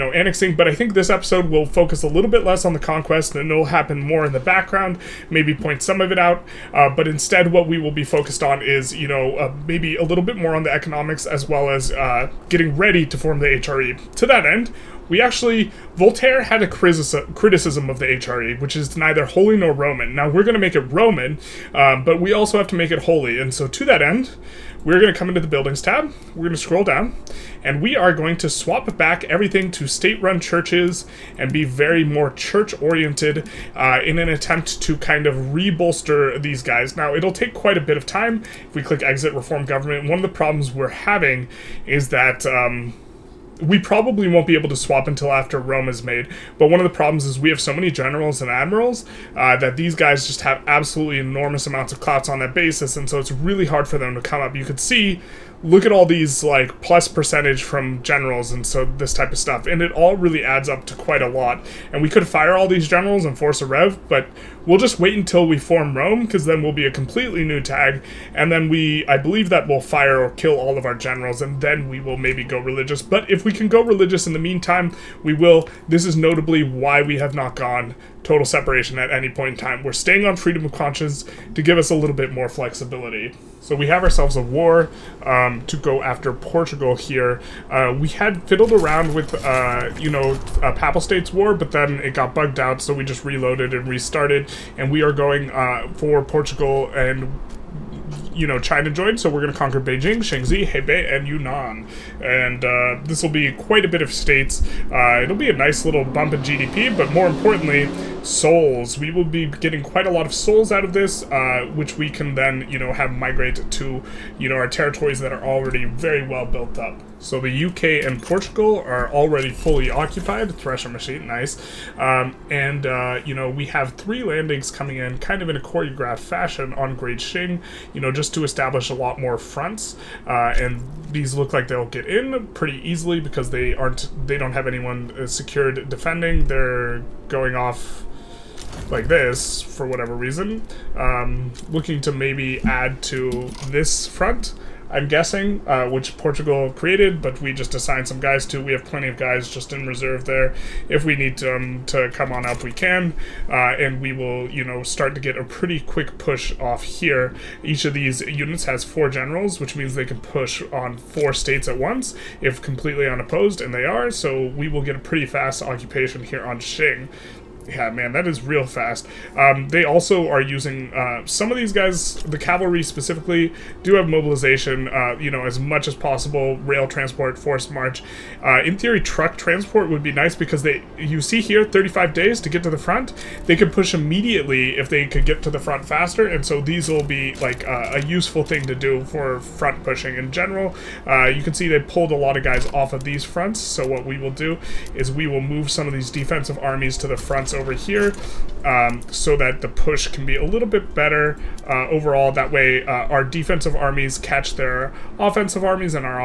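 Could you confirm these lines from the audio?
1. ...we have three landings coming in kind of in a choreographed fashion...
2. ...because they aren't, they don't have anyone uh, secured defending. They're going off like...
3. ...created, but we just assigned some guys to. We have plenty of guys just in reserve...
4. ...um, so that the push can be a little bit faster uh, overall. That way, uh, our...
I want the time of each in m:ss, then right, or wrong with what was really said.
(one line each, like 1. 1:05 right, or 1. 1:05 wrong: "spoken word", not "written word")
1. 2:03 right
2. 2:13 right
3. 2:26 right
4. 3:18 wrong: "better", not "faster".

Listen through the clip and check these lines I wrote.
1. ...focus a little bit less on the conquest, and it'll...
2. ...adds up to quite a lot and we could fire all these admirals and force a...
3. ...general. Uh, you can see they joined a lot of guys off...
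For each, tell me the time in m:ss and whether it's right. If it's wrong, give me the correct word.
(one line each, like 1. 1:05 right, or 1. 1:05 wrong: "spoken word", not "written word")
1. 0:01 right
2. 1:00 wrong: "generals", not "admirals"
3. 3:10 wrong: "pulled", not "joined".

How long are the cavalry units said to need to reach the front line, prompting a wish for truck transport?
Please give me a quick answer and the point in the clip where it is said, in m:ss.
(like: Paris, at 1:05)
35 days, at 3:01.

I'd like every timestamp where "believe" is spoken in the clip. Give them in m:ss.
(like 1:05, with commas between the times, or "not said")
1:09.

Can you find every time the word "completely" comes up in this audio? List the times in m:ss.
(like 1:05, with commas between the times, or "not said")
1:06, 2:42.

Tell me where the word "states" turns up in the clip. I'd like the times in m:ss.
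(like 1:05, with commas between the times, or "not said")
0:29, 1:31, 1:44, 2:41.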